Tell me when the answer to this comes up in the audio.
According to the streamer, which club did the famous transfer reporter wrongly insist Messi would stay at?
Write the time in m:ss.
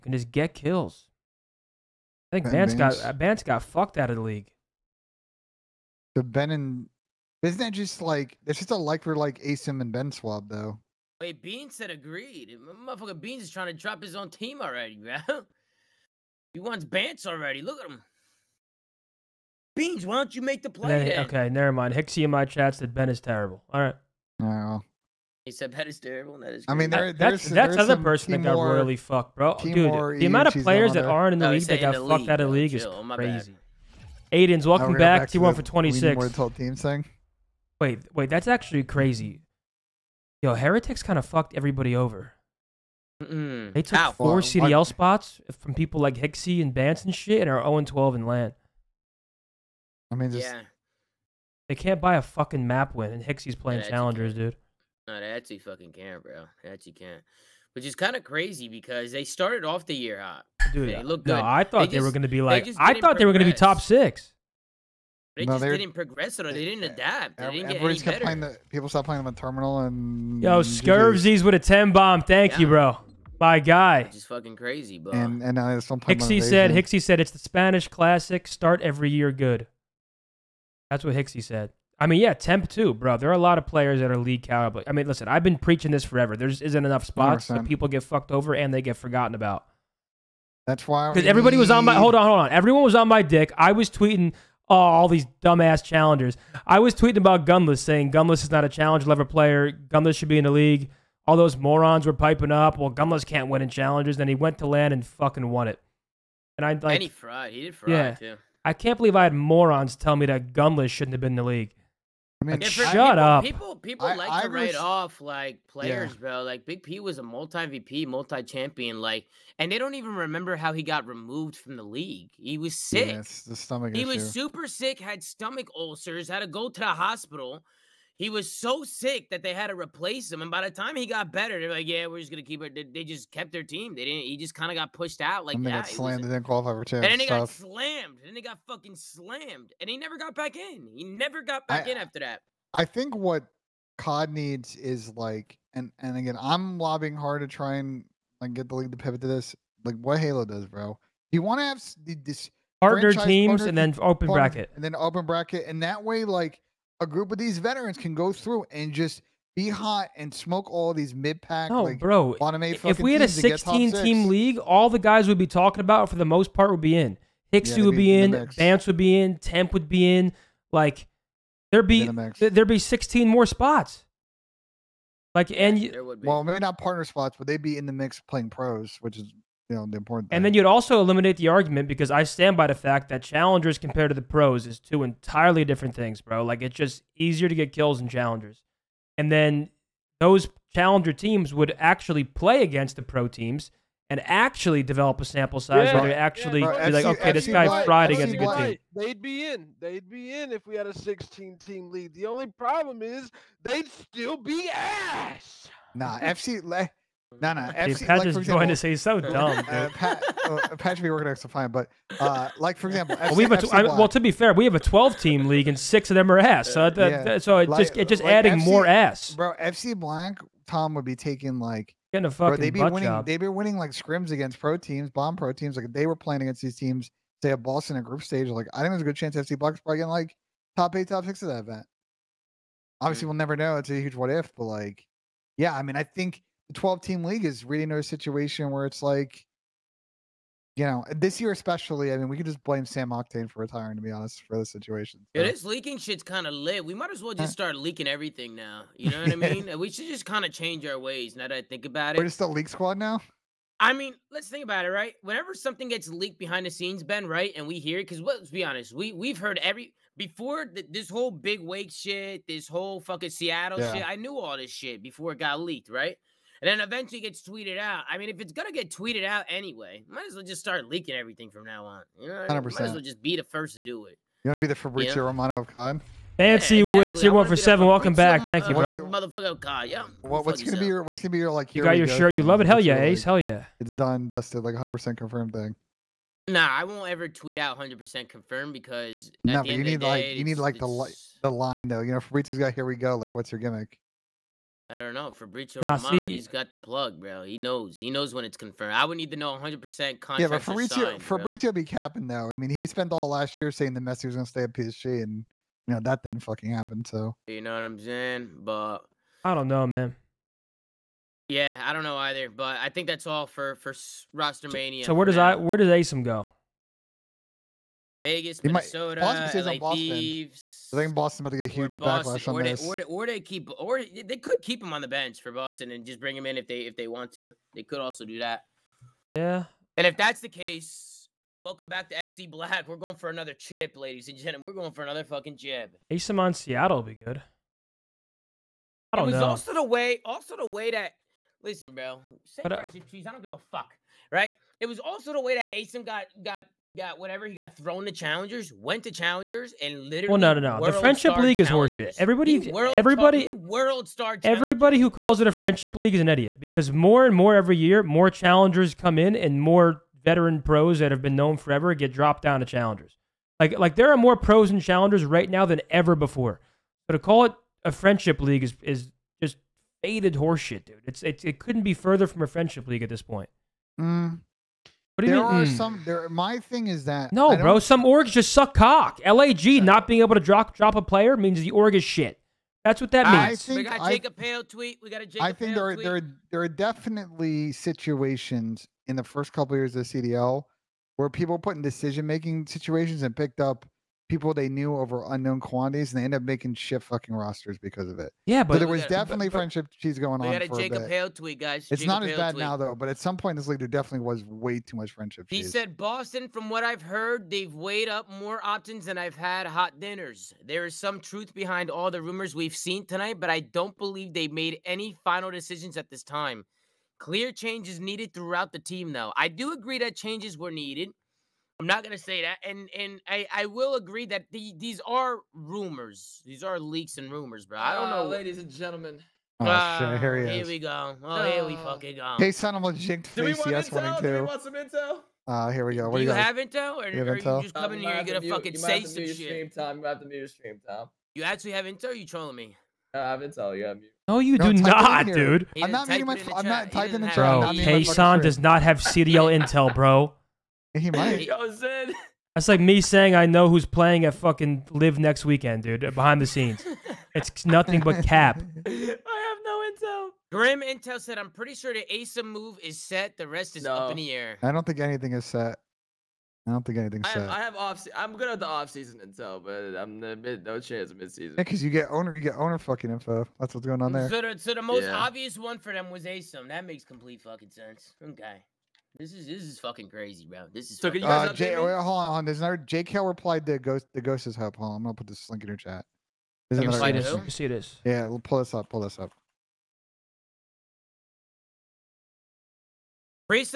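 5:04.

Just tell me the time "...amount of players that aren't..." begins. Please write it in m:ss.
0:30.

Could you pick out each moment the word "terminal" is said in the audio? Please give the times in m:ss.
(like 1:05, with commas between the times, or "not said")
1:09.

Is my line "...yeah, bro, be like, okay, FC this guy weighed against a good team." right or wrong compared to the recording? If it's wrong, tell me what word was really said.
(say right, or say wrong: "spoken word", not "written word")
wrong: "fried", not "weighed".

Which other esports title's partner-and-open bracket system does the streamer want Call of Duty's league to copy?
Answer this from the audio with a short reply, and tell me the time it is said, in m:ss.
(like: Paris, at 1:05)
Halo, at 2:30.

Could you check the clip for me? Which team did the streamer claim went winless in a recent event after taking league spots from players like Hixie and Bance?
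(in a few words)
Heretics.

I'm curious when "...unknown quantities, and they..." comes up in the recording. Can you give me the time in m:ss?
6:35.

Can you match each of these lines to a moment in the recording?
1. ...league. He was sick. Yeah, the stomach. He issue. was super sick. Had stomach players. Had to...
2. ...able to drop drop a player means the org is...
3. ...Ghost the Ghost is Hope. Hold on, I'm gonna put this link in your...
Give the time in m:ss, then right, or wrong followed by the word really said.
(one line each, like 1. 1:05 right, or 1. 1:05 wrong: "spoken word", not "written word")
1. 2:01 wrong: "ulcers", not "players"
2. 6:20 right
3. 8:03 right.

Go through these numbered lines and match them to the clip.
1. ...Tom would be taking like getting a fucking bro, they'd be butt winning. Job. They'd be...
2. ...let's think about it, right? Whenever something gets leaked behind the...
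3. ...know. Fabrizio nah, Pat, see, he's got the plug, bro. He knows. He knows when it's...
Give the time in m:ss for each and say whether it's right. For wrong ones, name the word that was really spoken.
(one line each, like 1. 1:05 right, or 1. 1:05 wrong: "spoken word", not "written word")
1. 3:40 right
2. 4:14 right
3. 4:55 wrong: "Romano", not "Pat".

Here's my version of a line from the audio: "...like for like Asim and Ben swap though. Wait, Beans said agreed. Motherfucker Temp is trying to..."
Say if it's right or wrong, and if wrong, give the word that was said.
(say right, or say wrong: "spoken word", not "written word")
wrong: "Beans", not "Temp".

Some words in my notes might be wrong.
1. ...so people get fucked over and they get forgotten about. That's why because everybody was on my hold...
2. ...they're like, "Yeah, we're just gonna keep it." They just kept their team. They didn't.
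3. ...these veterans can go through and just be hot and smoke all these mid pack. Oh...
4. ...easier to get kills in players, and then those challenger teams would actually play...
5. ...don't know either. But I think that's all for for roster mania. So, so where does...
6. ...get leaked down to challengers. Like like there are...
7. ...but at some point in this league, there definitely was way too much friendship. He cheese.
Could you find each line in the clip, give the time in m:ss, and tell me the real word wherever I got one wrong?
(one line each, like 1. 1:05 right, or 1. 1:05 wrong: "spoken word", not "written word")
1. 1:27 right
2. 2:11 right
3. 2:37 right
4. 3:07 wrong: "challengers", not "players"
5. 5:11 right
6. 6:01 wrong: "dropped", not "leaked"
7. 6:42 right.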